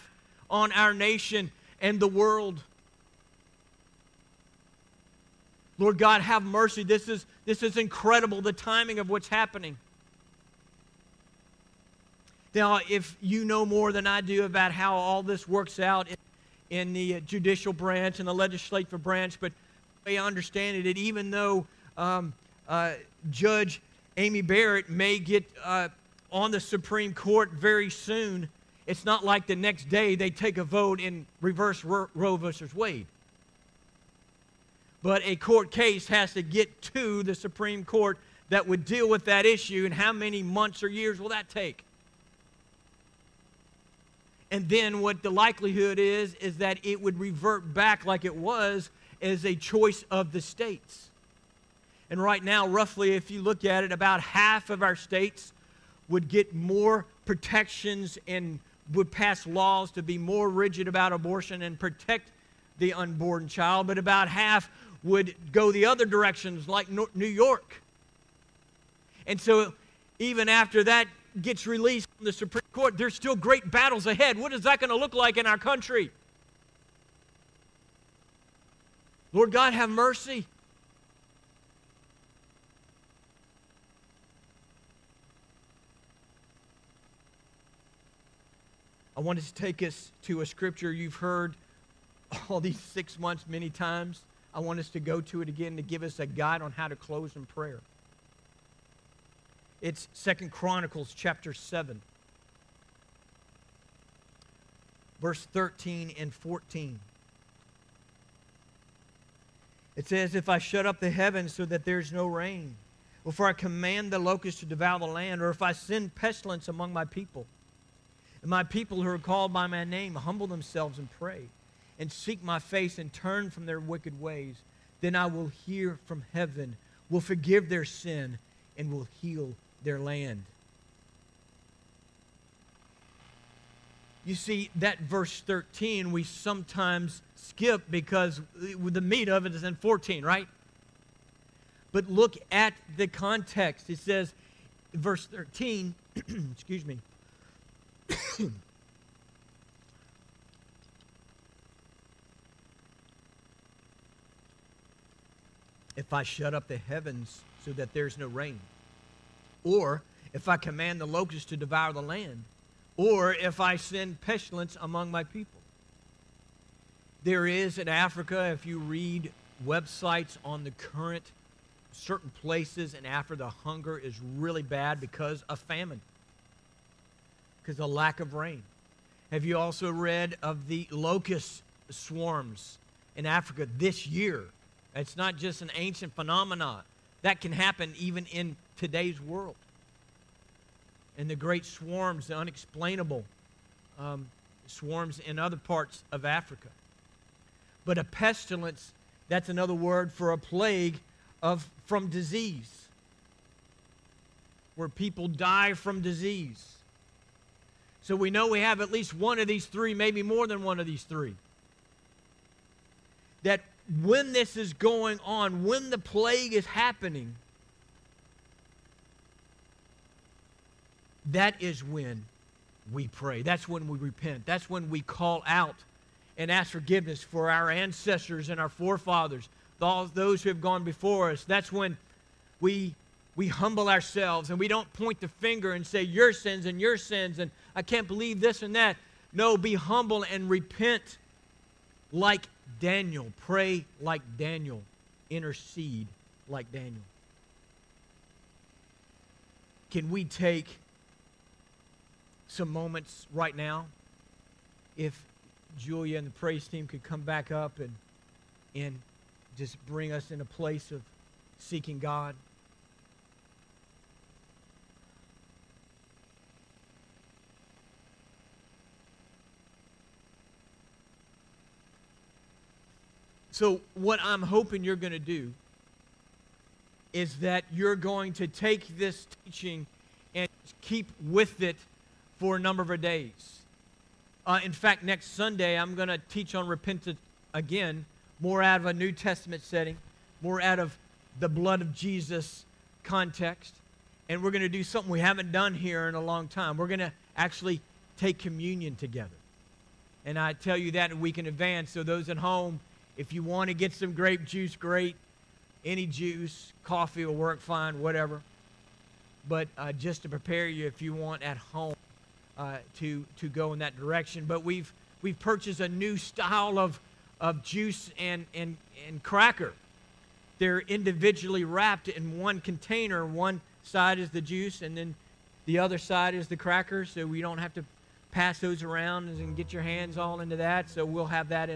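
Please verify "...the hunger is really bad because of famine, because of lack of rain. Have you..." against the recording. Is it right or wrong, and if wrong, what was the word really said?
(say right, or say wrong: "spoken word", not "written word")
right.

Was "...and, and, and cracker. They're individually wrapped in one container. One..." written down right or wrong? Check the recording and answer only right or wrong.
right.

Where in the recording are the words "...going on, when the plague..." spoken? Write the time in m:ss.
3:34.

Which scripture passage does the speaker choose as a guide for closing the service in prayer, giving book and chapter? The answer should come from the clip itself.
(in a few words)
2 Chronicles 7.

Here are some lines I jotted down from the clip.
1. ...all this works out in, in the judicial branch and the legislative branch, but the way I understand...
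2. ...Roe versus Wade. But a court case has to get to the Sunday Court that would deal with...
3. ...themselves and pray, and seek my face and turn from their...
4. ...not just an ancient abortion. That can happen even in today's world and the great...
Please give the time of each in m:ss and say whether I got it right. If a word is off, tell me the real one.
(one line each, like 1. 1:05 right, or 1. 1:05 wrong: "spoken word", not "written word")
1. 0:14 right
2. 0:32 wrong: "Supreme", not "Sunday"
3. 2:00 right
4. 3:05 wrong: "phenomenon", not "abortion".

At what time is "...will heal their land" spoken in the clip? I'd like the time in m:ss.
2:08.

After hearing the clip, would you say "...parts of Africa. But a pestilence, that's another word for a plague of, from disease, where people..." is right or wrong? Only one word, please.
right.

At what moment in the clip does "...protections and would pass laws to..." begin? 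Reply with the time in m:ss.
0:57.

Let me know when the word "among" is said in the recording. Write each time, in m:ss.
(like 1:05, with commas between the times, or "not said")
1:56, 2:44.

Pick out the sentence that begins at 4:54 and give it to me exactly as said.
And we're going to do something we haven't done here in a long time.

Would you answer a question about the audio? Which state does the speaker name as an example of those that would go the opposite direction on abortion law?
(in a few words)
New York.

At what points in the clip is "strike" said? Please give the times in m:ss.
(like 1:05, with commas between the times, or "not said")
not said.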